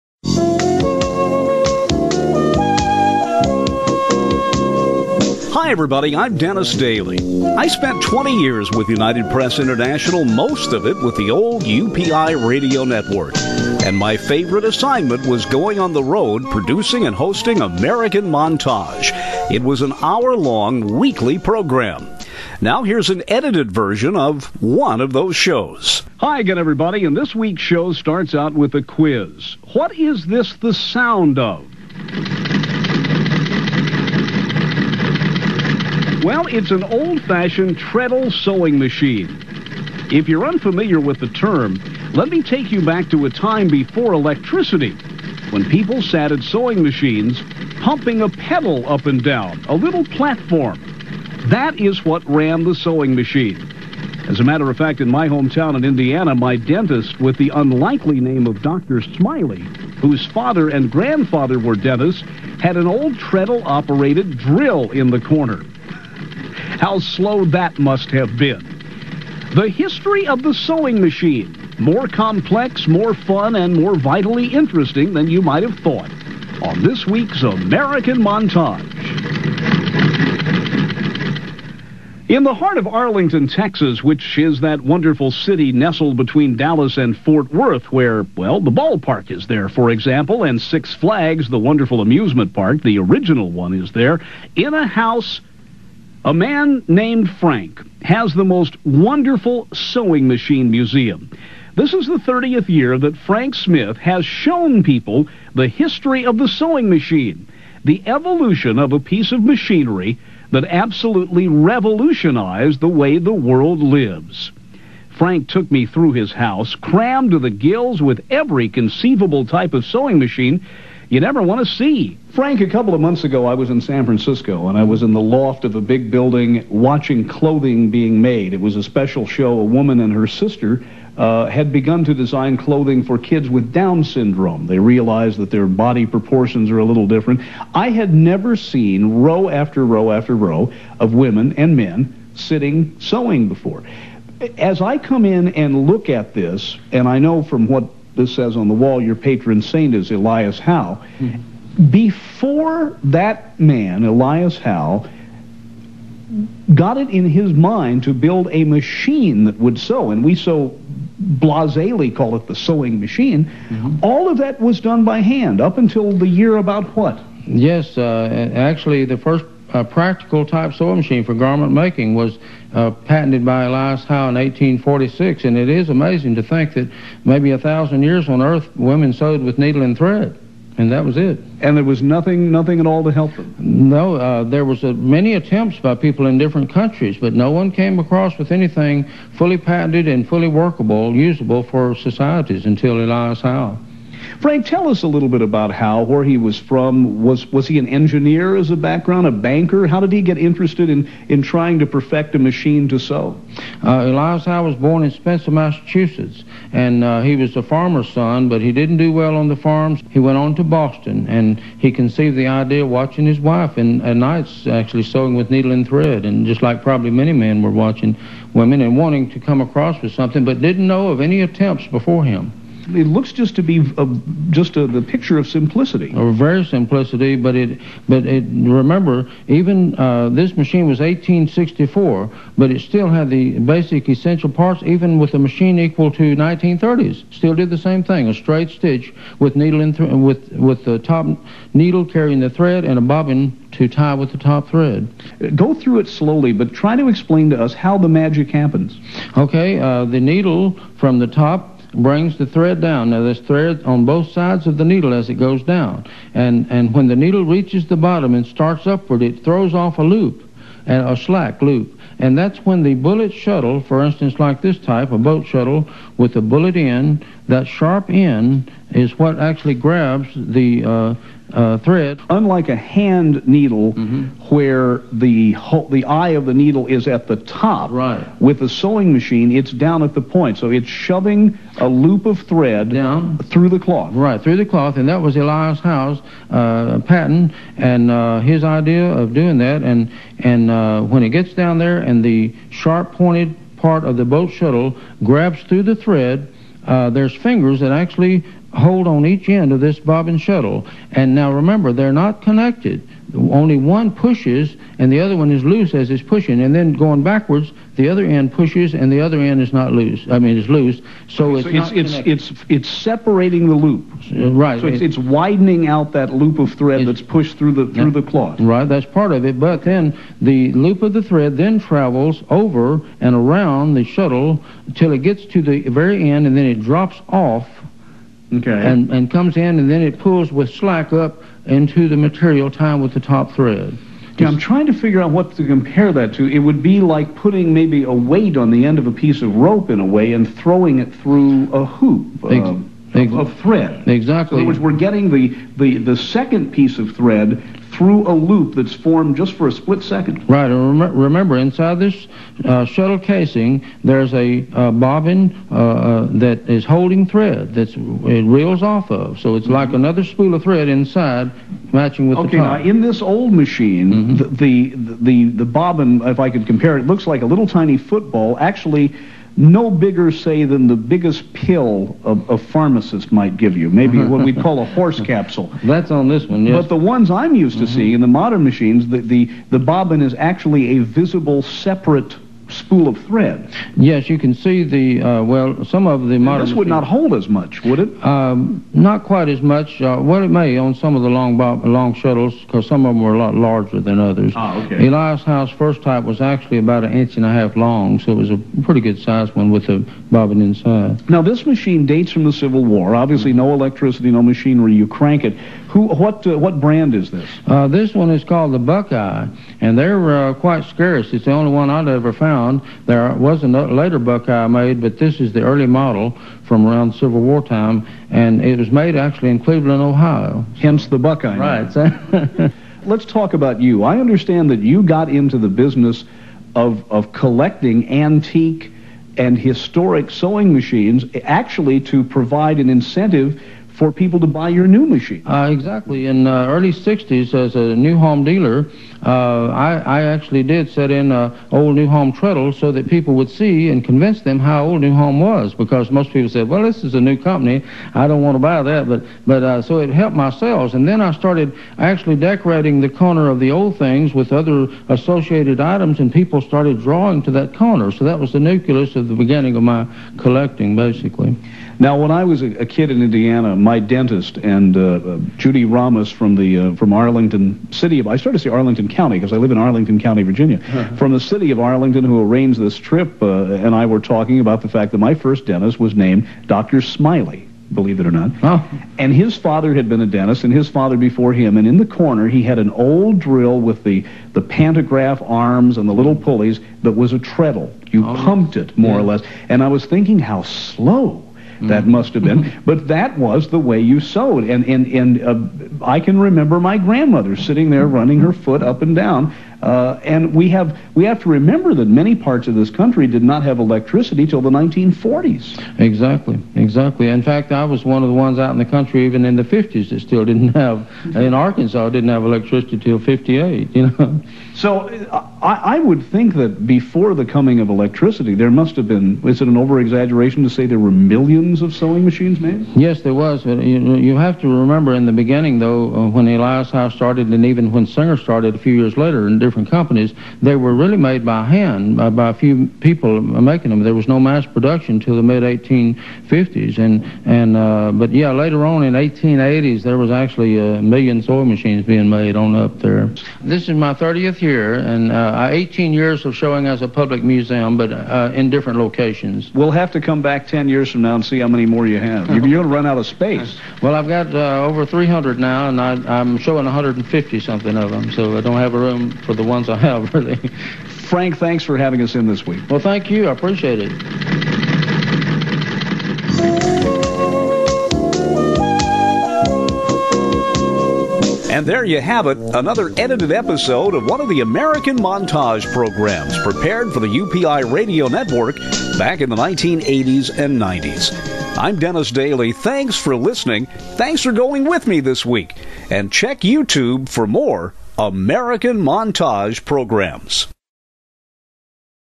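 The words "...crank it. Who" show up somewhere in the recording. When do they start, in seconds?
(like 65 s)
405 s.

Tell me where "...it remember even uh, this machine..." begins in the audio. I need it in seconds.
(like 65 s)
228 s.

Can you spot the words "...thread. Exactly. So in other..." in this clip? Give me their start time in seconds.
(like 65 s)
343 s.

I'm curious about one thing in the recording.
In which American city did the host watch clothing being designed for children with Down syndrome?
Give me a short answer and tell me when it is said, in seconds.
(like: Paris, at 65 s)
San Francisco, at 123 s.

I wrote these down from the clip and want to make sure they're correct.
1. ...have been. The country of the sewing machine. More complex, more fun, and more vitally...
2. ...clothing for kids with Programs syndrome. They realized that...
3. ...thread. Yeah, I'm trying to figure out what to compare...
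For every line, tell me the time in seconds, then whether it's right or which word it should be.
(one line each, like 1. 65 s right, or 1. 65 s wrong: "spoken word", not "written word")
1. 68 s wrong: "history", not "country"
2. 132 s wrong: "Down", not "Programs"
3. 333 s right.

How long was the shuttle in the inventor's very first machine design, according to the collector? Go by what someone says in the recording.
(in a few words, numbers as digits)
an inch and a half.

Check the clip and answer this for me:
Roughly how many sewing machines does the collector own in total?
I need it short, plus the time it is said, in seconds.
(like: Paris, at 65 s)
over 300, at 554 s.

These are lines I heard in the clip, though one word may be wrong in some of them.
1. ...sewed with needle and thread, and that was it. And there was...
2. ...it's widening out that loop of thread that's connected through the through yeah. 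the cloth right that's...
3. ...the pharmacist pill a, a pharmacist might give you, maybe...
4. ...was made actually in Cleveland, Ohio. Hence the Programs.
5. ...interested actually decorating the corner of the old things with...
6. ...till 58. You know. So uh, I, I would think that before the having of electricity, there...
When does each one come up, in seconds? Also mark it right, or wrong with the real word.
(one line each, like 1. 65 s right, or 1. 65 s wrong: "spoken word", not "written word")
1. 179 s right
2. 315 s wrong: "pushed", not "connected"
3. 370 s wrong: "biggest", not "pharmacist"
4. 418 s wrong: "Buckeye", not "Programs"
5. 451 s wrong: "started", not "interested"
6. 512 s wrong: "coming", not "having".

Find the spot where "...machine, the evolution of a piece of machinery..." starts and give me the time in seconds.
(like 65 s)
106 s.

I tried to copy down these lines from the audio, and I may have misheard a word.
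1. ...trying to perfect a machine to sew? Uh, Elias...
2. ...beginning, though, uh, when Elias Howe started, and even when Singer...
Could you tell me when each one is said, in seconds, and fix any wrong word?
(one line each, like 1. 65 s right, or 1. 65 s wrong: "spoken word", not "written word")
1. 201 s right
2. 525 s right.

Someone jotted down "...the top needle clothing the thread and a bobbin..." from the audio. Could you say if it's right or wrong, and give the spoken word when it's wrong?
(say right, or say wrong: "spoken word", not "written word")
wrong: "carrying", not "clothing".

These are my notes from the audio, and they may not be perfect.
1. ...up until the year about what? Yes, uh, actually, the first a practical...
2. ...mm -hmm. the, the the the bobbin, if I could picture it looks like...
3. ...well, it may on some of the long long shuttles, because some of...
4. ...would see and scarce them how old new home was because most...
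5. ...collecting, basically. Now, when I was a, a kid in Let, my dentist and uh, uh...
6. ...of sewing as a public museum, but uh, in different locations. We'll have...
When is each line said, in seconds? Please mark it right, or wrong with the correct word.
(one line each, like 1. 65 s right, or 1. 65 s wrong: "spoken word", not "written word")
1. 165 s right
2. 364 s wrong: "compare", not "picture"
3. 390 s right
4. 443 s wrong: "convince", not "scarce"
5. 460 s wrong: "Indiana", not "Let"
6. 546 s wrong: "showing", not "sewing".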